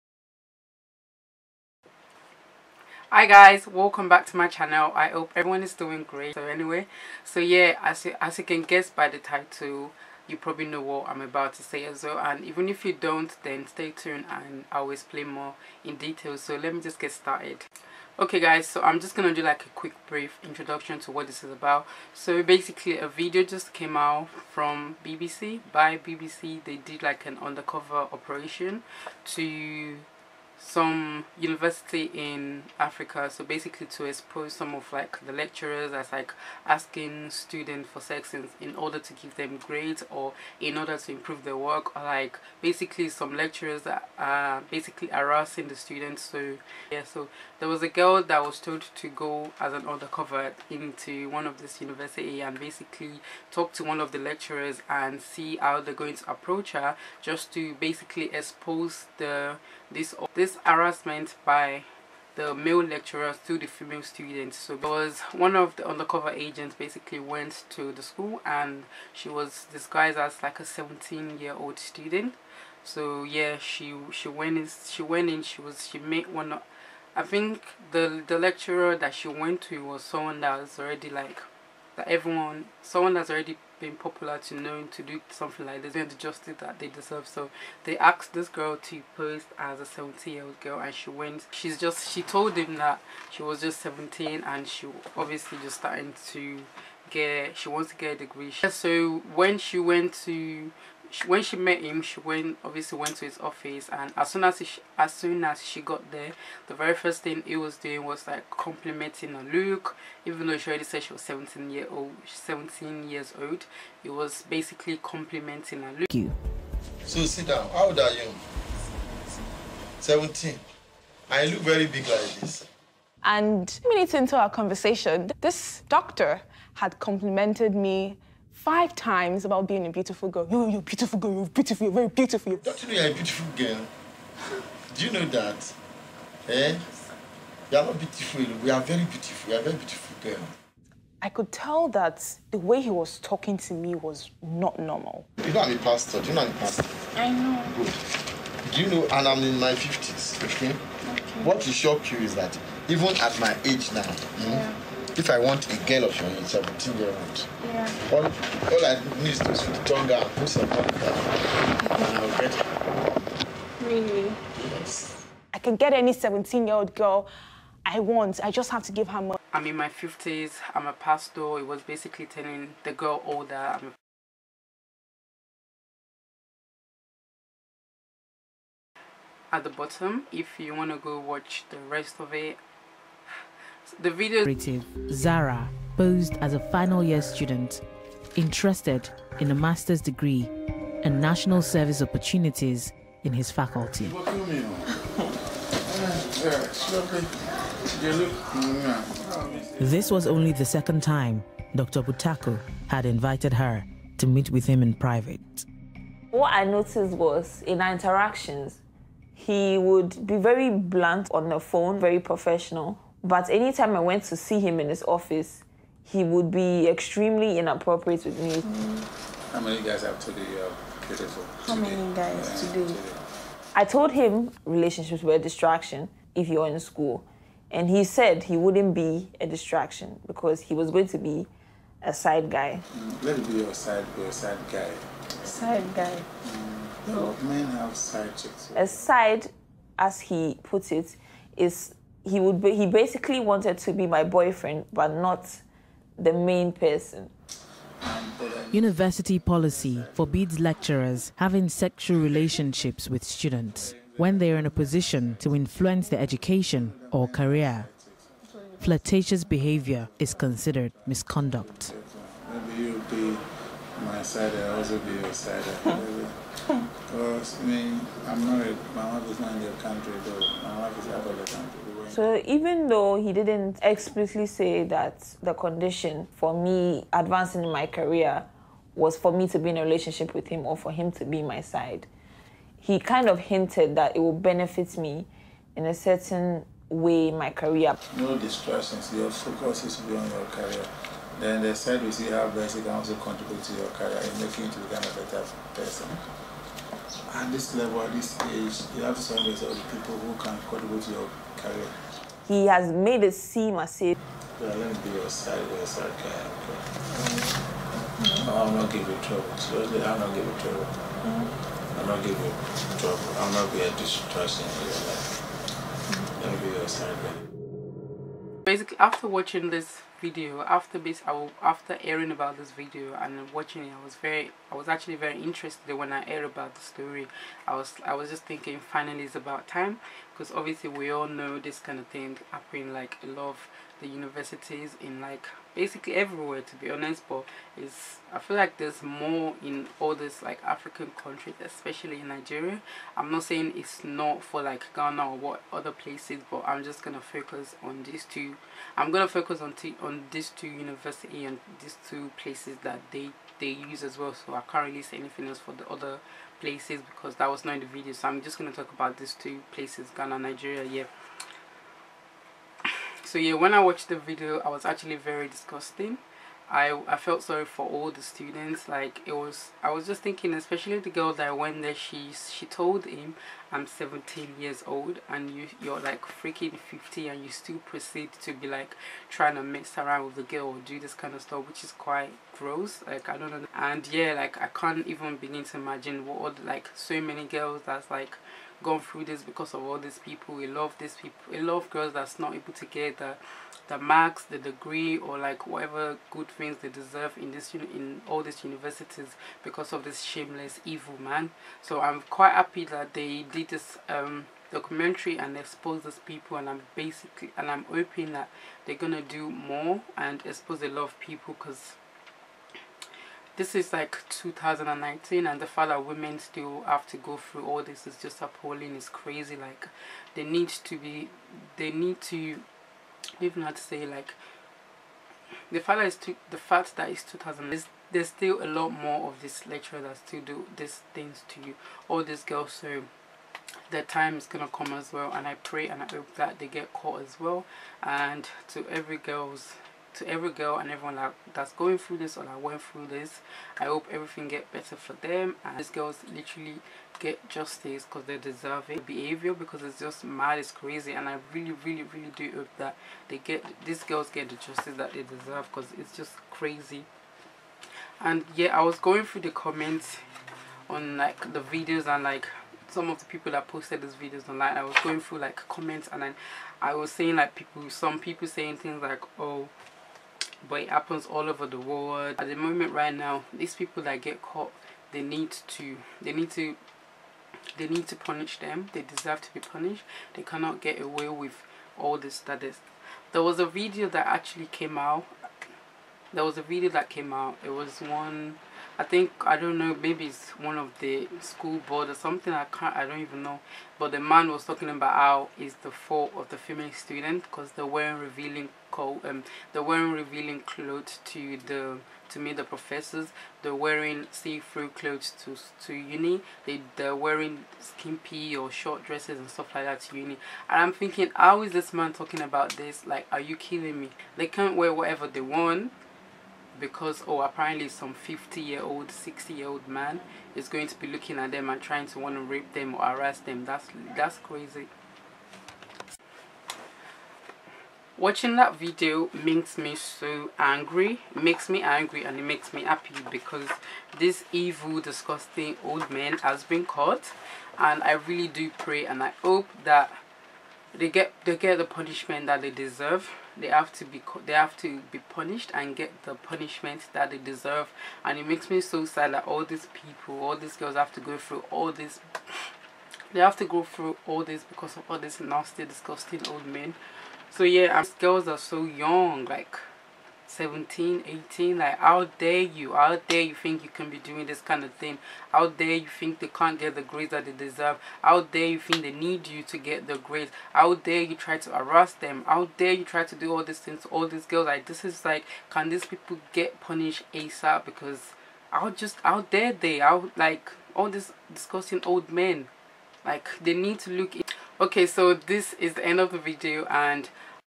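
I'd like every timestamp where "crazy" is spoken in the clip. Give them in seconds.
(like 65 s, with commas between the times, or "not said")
419 s, 450 s, 456 s, 524 s.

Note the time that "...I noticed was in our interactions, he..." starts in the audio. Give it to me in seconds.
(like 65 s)
206 s.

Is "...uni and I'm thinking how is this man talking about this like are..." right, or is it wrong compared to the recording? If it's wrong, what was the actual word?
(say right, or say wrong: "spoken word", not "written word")
right.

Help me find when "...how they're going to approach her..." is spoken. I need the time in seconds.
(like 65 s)
55 s.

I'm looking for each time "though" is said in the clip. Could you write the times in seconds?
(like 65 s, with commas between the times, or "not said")
110 s, 272 s.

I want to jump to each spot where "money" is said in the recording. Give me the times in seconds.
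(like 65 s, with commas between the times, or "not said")
169 s.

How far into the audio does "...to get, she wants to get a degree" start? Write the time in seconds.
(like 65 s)
96 s.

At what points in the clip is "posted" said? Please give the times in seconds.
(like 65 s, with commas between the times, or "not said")
463 s.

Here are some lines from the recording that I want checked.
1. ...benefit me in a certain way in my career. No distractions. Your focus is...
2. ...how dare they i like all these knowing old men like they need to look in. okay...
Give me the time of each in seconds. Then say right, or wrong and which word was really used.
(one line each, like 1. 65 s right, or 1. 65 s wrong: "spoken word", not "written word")
1. 284 s right
2. 579 s wrong: "disgusting", not "knowing".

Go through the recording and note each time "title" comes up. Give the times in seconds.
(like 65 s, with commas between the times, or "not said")
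9 s.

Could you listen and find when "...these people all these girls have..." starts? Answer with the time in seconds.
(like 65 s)
549 s.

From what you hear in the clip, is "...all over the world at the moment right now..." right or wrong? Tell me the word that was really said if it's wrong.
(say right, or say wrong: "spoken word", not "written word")
right.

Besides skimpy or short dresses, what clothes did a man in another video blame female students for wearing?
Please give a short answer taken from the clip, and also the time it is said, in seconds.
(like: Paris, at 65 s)
See-through clothes, at 504 s.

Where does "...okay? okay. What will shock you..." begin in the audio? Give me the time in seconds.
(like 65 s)
150 s.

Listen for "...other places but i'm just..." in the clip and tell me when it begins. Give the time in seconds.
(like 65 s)
345 s.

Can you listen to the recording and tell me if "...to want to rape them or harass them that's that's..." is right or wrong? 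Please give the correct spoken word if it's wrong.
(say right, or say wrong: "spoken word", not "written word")
right.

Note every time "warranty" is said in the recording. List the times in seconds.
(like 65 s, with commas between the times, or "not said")
not said.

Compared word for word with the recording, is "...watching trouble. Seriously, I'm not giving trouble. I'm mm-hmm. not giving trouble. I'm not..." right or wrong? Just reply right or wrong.
wrong.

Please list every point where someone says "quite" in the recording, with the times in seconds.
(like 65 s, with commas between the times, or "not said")
381 s, 402 s.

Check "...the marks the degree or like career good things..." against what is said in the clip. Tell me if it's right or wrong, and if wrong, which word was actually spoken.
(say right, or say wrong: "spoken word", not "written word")
wrong: "whatever", not "career".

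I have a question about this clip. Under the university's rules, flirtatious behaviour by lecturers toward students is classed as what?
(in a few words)
Misconduct.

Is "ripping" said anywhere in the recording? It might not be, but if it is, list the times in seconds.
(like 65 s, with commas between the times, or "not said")
not said.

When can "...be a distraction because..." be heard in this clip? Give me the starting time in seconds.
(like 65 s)
228 s.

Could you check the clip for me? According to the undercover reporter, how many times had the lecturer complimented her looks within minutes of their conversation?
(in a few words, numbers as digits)
5 times.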